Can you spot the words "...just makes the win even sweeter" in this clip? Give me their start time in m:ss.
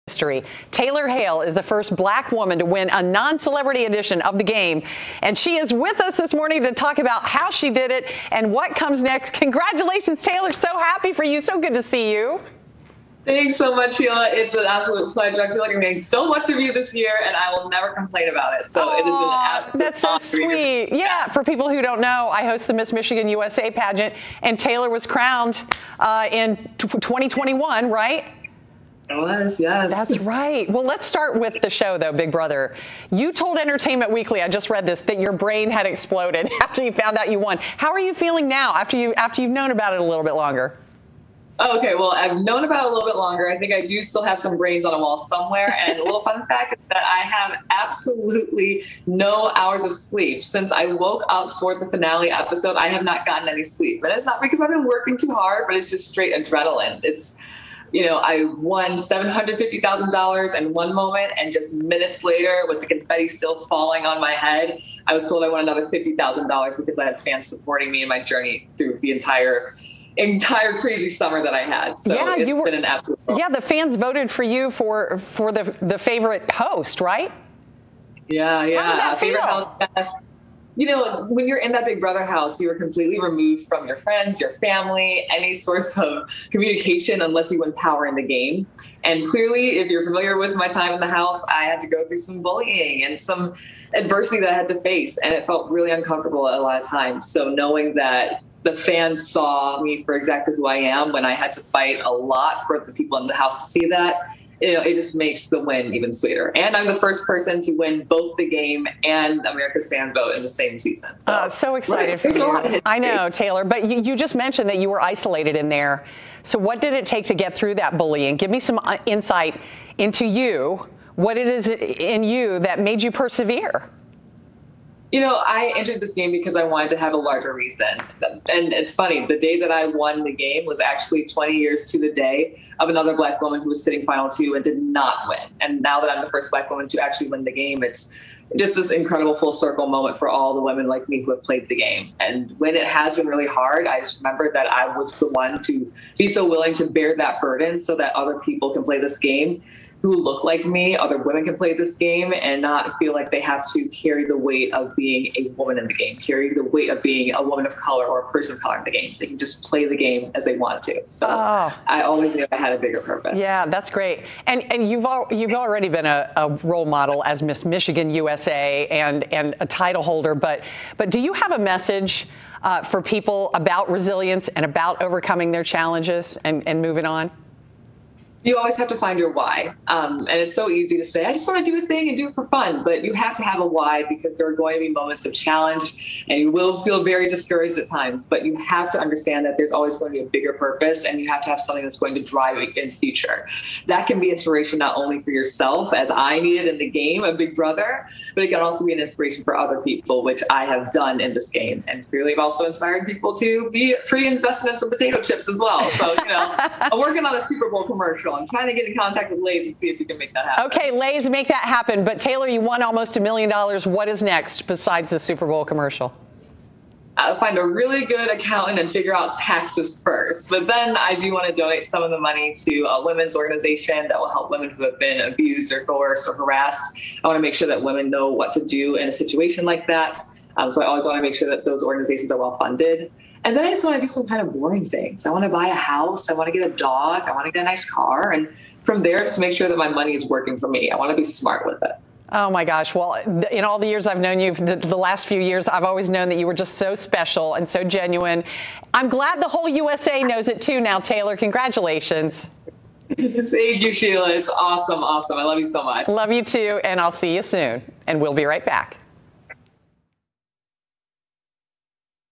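1:44.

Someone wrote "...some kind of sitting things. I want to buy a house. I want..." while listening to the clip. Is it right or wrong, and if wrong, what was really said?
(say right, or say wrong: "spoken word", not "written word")
wrong: "boring", not "sitting".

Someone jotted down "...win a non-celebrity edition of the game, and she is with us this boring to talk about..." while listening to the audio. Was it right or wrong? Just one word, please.
wrong.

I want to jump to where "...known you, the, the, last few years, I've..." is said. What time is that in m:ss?
4:04.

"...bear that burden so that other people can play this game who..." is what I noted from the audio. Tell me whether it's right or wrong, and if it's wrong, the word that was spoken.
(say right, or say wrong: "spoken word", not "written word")
right.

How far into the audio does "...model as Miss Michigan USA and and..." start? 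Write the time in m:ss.
2:46.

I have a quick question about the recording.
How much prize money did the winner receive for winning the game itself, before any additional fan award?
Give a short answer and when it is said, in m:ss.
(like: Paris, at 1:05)
$750,000, at 0:58.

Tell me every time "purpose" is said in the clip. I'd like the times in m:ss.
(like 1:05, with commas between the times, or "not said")
2:42, 3:10.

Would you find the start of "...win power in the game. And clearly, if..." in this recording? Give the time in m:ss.
1:27.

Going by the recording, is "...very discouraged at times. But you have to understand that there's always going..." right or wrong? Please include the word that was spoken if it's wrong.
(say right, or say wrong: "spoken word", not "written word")
right.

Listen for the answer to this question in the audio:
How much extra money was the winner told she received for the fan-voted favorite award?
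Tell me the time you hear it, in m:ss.
1:05.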